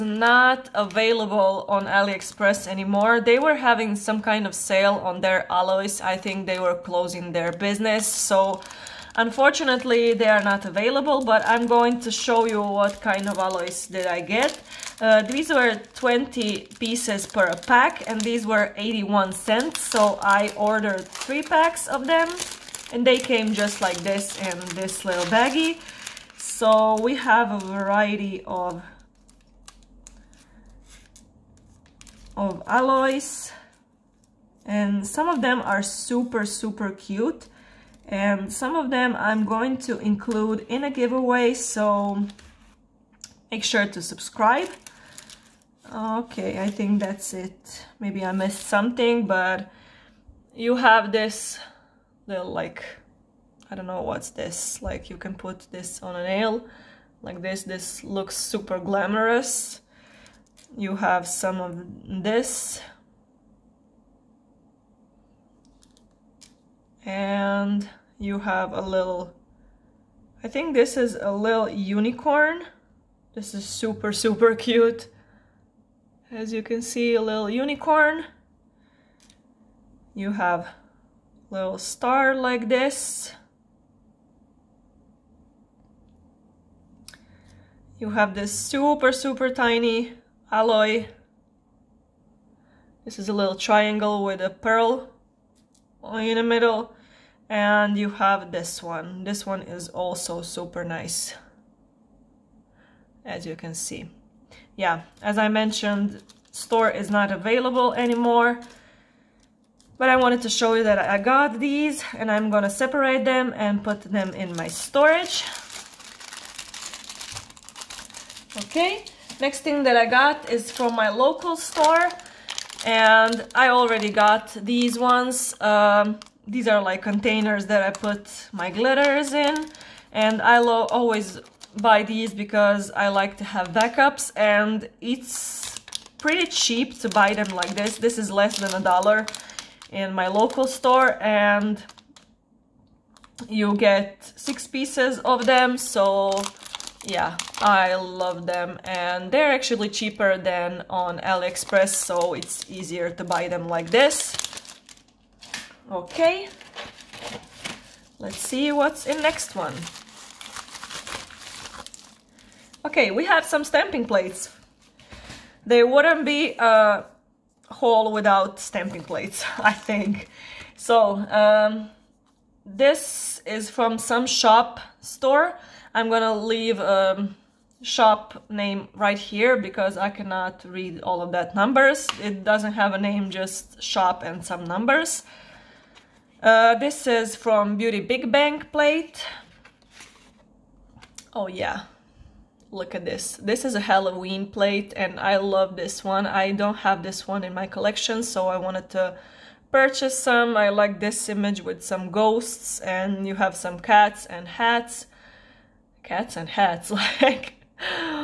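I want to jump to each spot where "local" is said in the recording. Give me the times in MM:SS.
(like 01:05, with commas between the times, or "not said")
02:01, 02:20.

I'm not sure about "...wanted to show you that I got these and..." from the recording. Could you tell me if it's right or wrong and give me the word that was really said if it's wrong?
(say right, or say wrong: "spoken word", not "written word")
right.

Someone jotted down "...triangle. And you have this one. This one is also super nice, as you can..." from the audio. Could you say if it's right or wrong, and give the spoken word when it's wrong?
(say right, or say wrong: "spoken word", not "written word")
wrong: "middle", not "triangle".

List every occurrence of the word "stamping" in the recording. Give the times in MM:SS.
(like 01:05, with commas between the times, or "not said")
02:43, 02:48.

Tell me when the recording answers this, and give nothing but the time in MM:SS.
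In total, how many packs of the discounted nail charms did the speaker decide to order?
00:21.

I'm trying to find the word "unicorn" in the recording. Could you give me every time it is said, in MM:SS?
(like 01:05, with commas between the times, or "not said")
01:11, 01:17.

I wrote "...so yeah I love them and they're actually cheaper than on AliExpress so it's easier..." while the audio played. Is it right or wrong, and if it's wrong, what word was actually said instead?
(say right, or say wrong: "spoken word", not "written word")
right.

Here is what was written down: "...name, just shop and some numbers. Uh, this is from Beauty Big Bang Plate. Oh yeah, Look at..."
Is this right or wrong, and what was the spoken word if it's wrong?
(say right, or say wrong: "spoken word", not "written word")
right.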